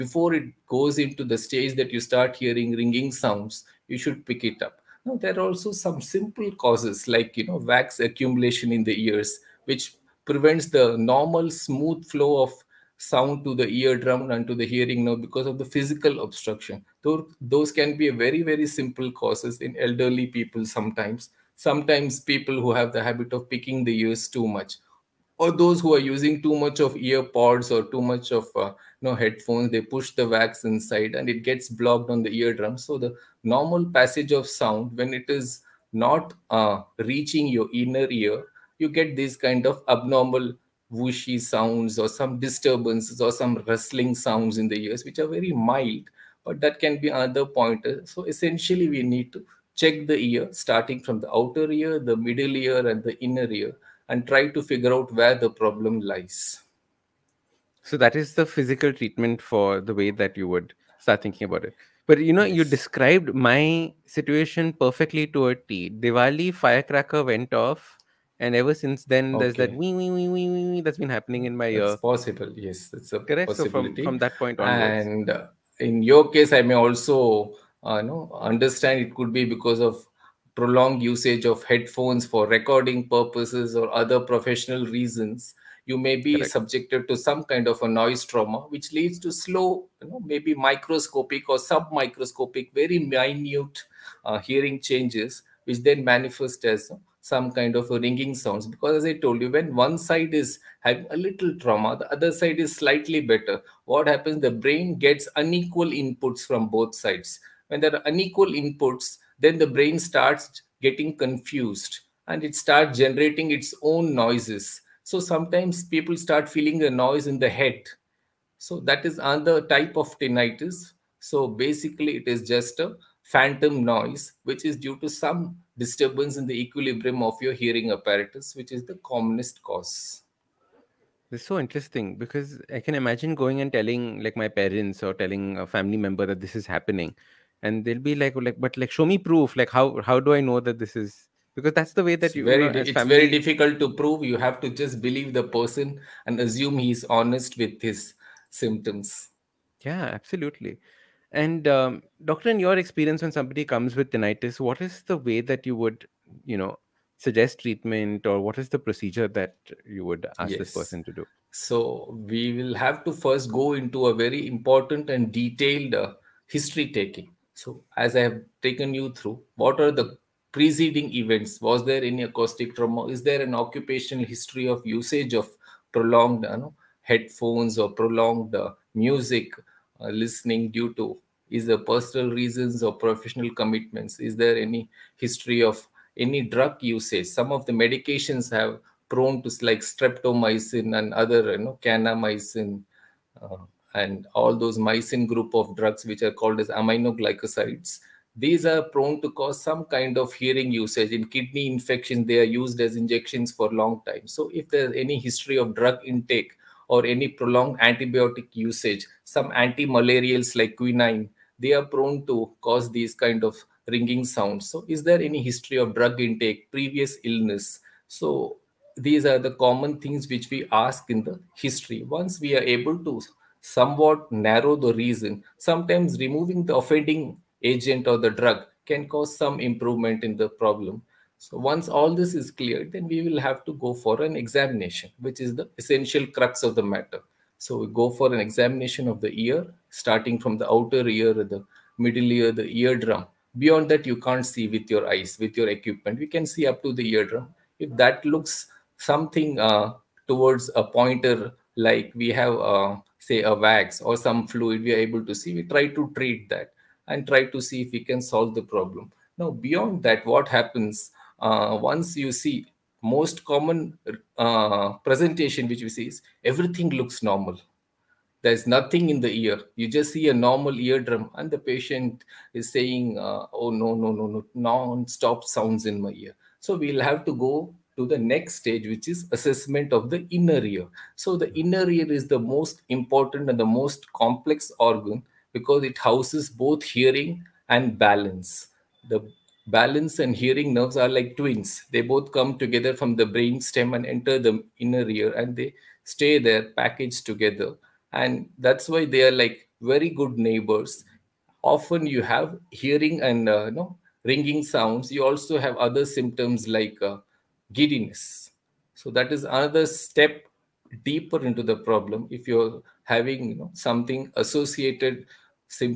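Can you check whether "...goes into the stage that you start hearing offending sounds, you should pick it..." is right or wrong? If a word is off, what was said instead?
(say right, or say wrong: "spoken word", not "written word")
wrong: "ringing", not "offending".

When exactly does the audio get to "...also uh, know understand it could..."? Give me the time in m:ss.
1:16.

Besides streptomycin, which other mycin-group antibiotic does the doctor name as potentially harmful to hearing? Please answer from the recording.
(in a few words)
kanamycin.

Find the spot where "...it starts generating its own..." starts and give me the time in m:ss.
1:52.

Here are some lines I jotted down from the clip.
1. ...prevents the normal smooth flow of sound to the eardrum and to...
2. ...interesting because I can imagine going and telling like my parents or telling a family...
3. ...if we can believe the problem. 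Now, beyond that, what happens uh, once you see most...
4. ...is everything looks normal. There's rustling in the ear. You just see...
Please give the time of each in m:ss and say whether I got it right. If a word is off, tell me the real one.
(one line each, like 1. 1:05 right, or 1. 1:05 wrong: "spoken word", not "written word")
1. 0:10 right
2. 2:11 right
3. 4:17 wrong: "solve", not "believe"
4. 4:26 wrong: "nothing", not "rustling".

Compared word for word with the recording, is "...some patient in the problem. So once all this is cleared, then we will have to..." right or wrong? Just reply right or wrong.
wrong.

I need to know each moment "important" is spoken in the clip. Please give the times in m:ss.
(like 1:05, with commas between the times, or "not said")
2:44, 4:42.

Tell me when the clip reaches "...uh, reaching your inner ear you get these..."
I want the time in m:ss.
0:36.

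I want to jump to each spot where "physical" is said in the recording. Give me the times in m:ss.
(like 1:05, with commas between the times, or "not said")
0:15, 0:58.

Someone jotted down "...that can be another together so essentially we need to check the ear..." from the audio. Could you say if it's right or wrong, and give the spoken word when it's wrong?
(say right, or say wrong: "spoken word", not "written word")
wrong: "pointer", not "together".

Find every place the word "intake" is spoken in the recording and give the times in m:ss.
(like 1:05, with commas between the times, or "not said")
3:26, 3:36.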